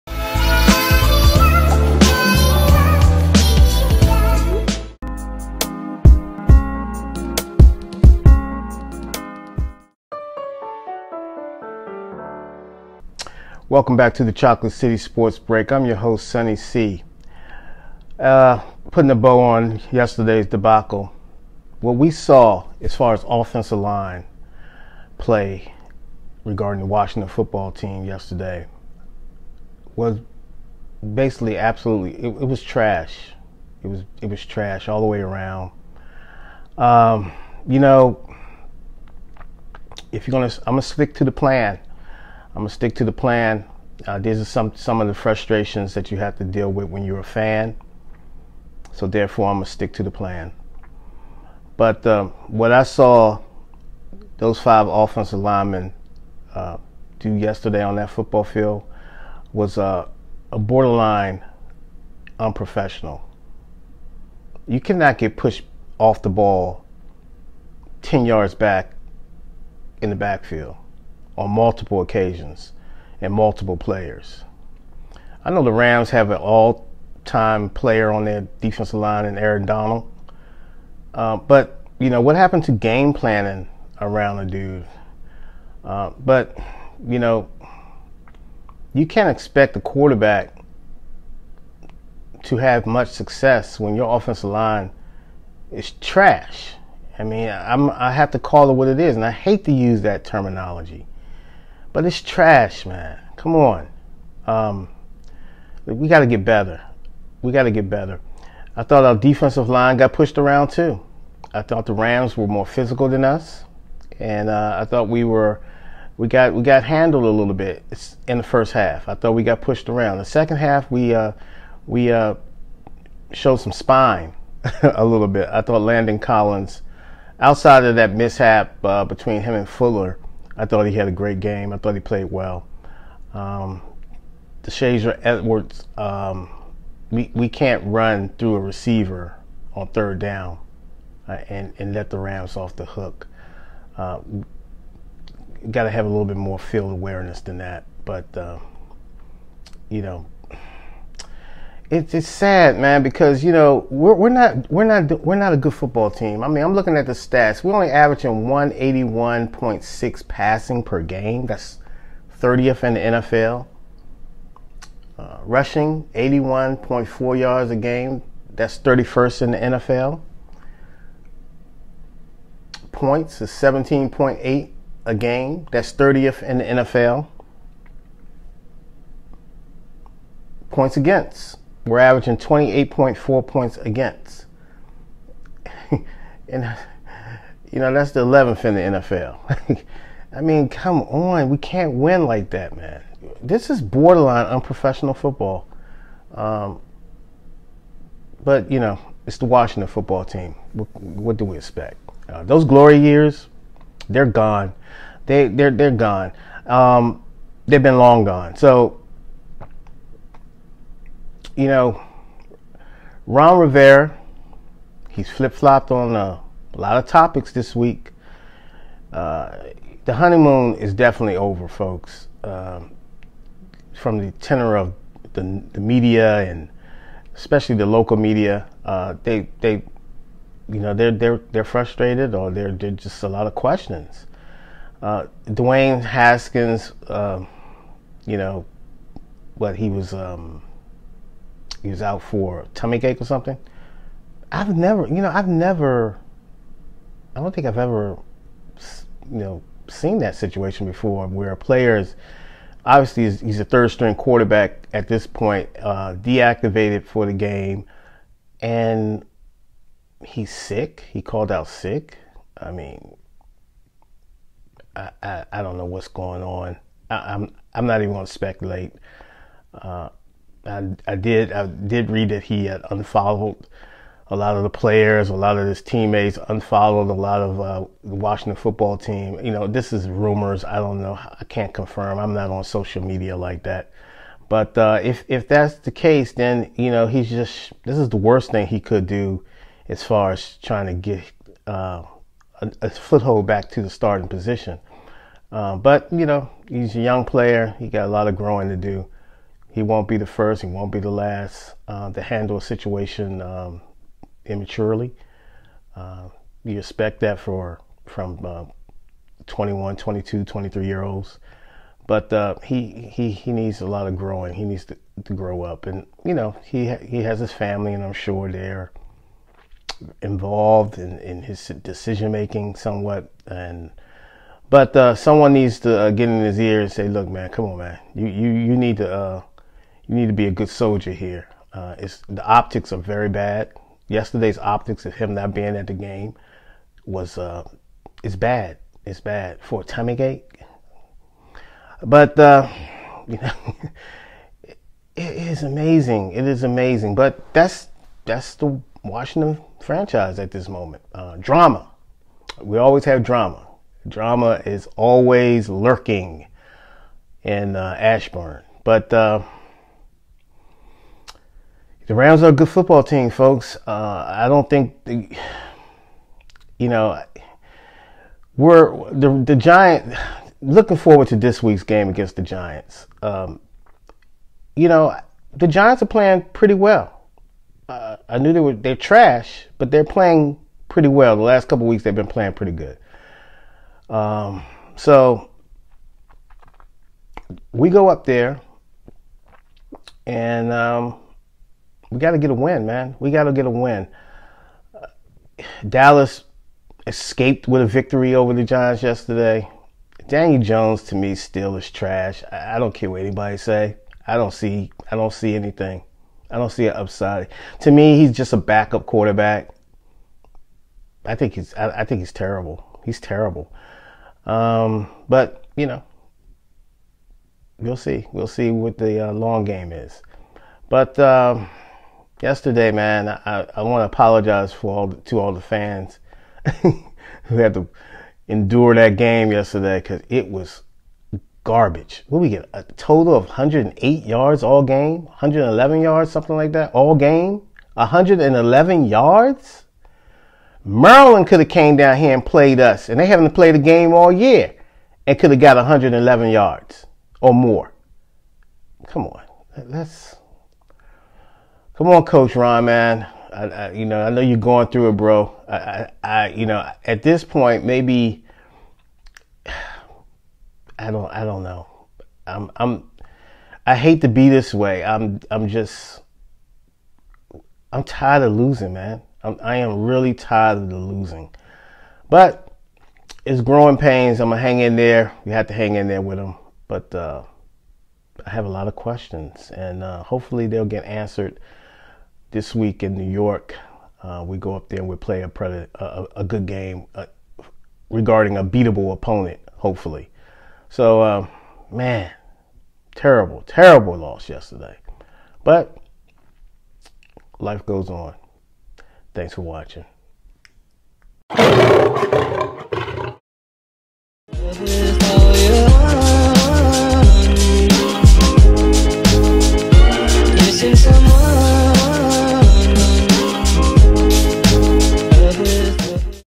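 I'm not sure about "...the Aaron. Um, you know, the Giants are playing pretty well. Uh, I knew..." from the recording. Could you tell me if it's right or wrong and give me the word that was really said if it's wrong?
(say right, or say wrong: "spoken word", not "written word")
wrong: "Giants", not "Aaron".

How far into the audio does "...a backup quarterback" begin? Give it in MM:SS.
06:48.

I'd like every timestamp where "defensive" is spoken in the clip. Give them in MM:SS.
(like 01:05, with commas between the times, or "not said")
01:18, 01:49.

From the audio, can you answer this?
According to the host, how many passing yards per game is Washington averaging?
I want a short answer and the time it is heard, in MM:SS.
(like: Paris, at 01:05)
181.6, at 02:38.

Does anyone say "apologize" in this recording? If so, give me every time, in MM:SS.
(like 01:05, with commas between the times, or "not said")
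07:04.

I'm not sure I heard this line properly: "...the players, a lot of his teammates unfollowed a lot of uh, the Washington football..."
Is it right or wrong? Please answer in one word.
right.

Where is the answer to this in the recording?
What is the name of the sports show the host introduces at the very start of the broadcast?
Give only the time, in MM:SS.
00:14.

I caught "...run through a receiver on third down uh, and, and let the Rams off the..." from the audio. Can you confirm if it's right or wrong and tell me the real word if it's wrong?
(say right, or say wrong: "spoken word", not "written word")
right.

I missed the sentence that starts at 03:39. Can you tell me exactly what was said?
Uh, the honeymoon is definitely over, folks.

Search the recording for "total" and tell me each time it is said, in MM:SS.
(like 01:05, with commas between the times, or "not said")
07:12.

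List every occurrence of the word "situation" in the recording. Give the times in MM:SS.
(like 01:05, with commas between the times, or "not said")
04:10, 05:02.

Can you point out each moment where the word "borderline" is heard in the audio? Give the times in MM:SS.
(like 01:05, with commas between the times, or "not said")
01:00, 03:13.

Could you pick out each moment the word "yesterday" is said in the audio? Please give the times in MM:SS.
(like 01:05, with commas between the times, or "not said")
00:19, 00:28, 00:57, 05:34, 06:39, 07:02, 07:09, 08:14.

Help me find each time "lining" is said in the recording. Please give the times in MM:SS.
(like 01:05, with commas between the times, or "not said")
not said.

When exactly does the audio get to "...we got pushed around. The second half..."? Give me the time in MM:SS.
01:59.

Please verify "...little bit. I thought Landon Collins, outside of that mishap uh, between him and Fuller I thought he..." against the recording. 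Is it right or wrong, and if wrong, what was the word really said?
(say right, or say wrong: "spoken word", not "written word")
right.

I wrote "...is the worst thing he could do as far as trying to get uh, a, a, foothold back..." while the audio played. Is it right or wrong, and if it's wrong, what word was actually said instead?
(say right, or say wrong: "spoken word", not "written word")
right.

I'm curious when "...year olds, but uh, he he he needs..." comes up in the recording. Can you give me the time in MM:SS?
05:10.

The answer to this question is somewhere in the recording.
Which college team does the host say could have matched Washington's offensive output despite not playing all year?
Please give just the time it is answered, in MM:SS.
07:20.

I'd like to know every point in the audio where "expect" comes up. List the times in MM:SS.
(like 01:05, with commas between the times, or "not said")
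01:29, 03:21, 05:06.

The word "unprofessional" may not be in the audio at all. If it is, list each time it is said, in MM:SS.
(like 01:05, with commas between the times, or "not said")
01:02, 03:14.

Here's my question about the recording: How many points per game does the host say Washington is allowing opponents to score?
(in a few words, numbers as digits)
28.4.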